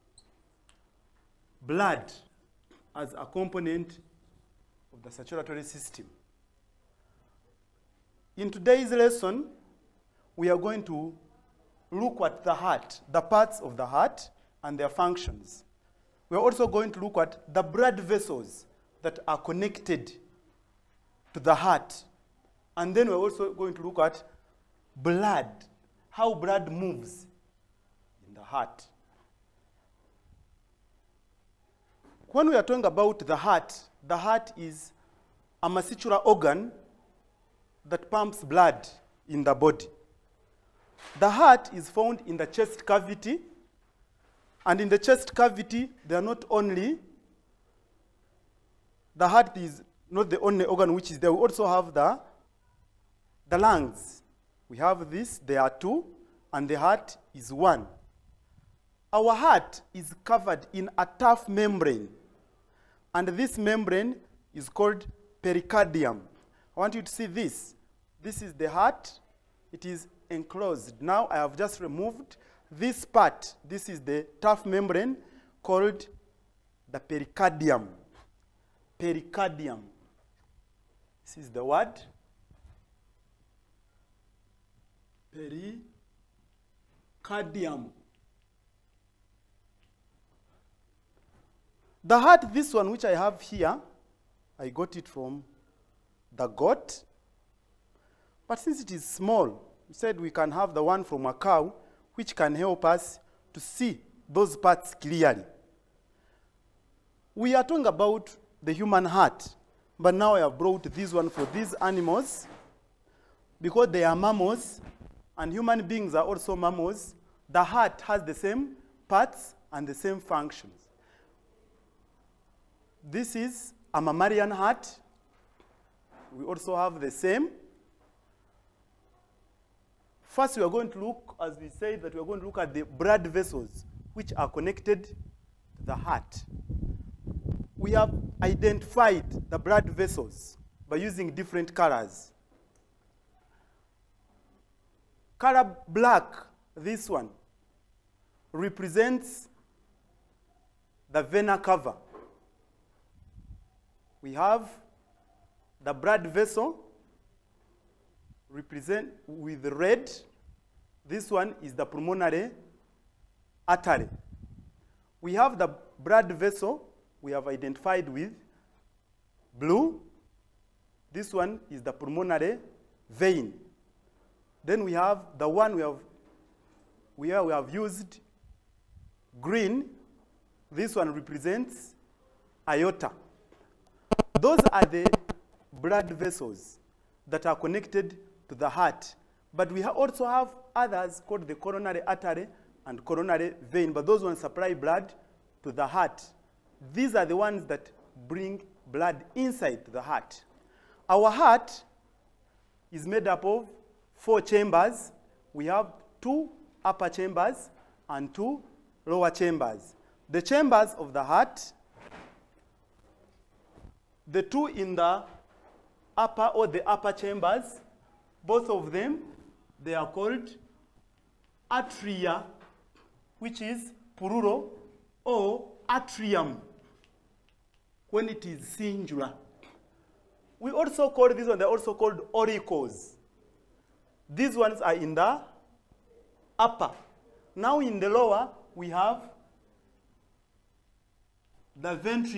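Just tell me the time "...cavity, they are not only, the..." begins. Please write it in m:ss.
0:45.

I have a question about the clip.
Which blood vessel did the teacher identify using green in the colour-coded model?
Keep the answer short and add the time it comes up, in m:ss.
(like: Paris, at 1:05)
aorta, at 3:02.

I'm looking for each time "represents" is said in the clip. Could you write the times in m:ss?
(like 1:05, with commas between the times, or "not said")
2:28, 2:38, 3:01.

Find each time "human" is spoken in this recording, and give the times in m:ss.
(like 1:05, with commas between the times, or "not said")
1:48, 1:55.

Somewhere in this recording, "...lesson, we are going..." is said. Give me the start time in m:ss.
0:08.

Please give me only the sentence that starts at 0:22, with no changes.
And then we're also going to look at blood, how blood moves heart.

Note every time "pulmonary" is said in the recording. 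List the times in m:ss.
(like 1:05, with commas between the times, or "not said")
2:41, 2:51.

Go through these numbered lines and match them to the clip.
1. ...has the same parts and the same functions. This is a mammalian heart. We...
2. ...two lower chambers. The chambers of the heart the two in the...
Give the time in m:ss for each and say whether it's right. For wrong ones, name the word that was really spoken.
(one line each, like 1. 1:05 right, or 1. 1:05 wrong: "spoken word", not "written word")
1. 1:58 right
2. 3:28 right.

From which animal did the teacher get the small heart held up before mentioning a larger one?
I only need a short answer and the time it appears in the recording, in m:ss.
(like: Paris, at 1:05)
goat, at 1:36.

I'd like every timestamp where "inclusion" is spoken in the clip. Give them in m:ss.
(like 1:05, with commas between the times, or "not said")
not said.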